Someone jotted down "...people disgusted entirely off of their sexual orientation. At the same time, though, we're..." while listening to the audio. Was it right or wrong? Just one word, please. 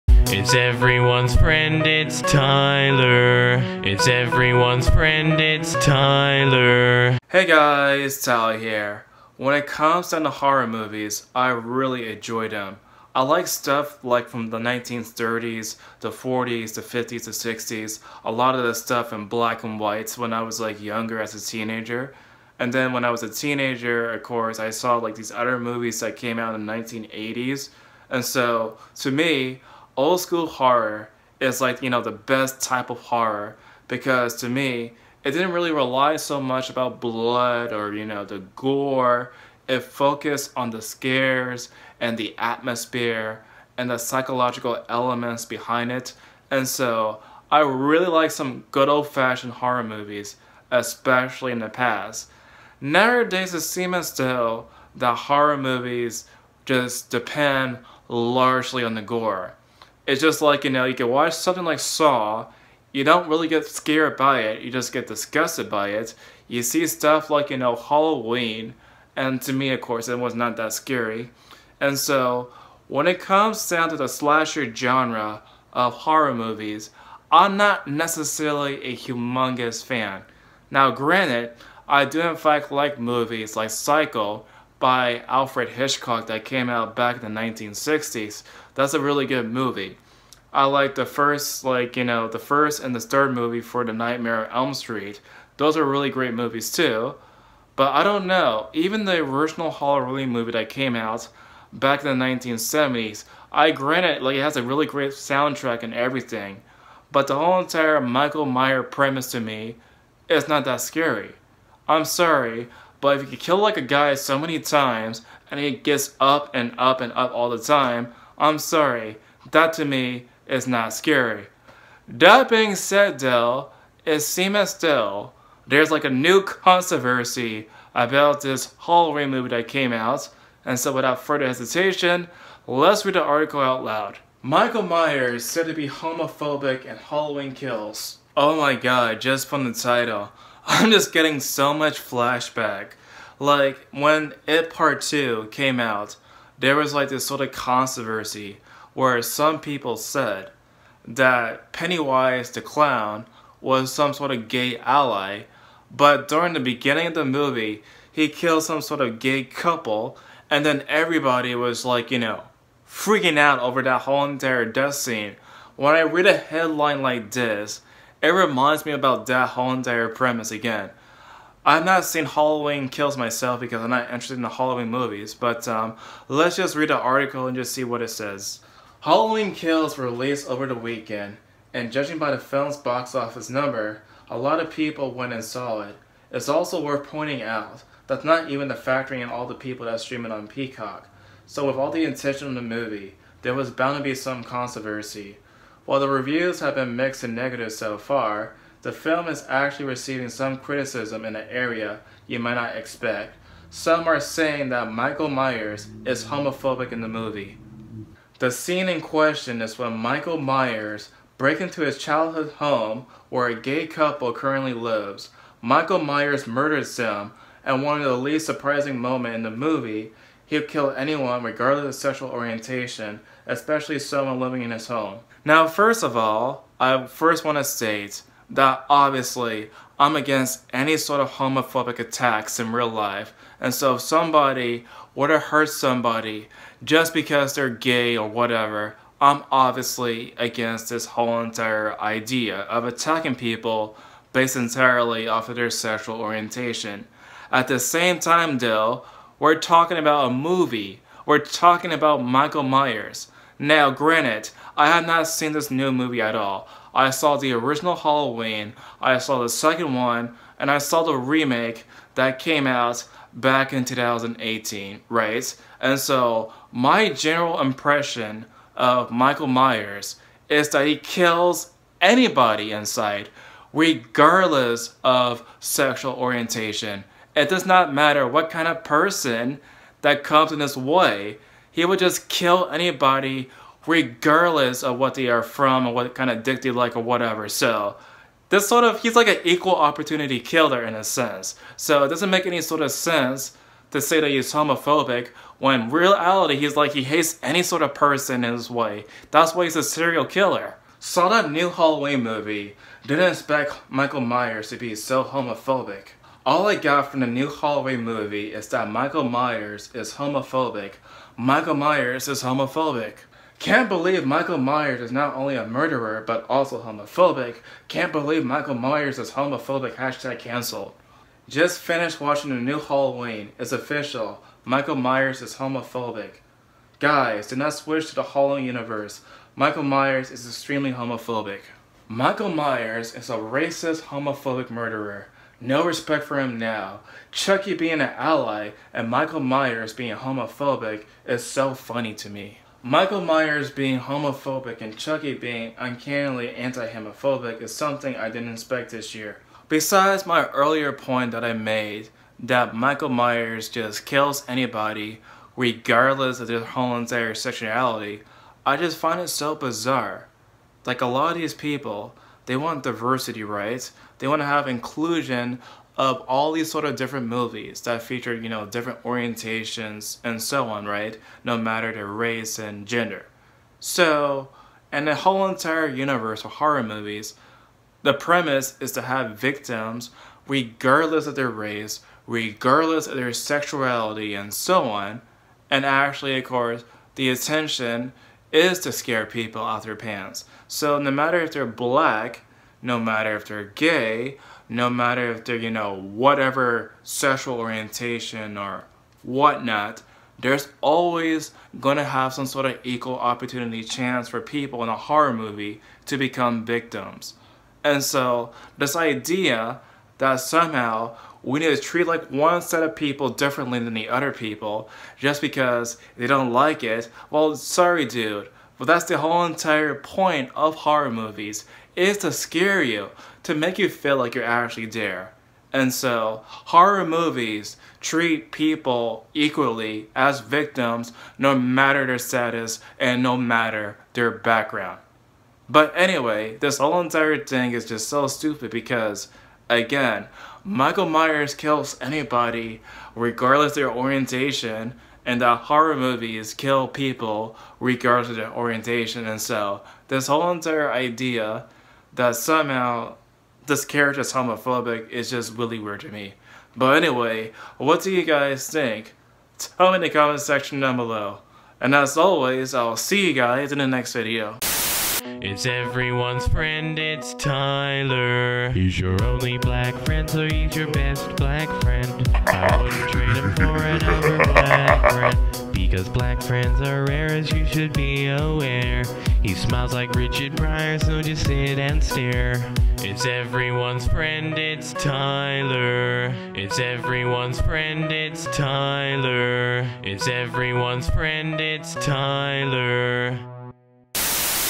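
wrong.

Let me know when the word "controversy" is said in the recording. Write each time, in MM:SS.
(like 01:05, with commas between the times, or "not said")
02:06, 02:27, 03:14.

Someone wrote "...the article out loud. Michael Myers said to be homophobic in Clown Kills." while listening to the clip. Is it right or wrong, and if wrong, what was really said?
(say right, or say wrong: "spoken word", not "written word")
wrong: "Halloween", not "Clown".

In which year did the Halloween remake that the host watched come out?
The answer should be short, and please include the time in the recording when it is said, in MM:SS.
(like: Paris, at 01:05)
2018, at 04:23.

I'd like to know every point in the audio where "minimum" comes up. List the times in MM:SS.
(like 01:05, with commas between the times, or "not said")
not said.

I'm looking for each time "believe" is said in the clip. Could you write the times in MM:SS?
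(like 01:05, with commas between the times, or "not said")
05:13, 05:18.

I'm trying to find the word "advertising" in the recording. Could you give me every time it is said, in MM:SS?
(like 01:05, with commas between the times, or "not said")
not said.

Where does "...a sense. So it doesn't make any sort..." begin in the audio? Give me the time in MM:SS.
04:50.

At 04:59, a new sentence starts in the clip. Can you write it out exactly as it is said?
That's why he's a serial killer.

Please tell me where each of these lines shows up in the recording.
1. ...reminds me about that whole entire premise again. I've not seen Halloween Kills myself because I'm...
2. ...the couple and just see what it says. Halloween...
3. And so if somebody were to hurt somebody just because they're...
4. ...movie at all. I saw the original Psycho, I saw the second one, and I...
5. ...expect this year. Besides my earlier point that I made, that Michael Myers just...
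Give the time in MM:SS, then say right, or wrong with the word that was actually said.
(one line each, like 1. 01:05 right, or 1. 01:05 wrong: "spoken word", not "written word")
1. 02:48 right
2. 02:56 wrong: "article", not "couple"
3. 03:53 right
4. 04:15 wrong: "Halloween", not "Psycho"
5. 05:48 right.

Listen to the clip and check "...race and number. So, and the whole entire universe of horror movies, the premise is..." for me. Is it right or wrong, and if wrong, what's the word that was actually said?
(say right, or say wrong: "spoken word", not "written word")
wrong: "gender", not "number".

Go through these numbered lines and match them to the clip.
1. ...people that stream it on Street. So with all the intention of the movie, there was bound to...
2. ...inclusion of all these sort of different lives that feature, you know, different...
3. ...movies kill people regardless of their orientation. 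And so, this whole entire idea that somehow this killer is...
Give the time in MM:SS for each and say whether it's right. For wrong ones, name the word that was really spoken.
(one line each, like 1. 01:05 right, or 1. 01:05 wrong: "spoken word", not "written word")
1. 03:09 wrong: "Peacock", not "Street"
2. 06:04 wrong: "movies", not "lives"
3. 07:25 wrong: "character", not "killer".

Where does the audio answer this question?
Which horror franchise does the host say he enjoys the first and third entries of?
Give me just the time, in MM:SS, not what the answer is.
01:33.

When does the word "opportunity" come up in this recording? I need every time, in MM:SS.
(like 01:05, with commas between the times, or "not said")
04:49, 06:43.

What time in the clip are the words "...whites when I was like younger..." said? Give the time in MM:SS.
00:19.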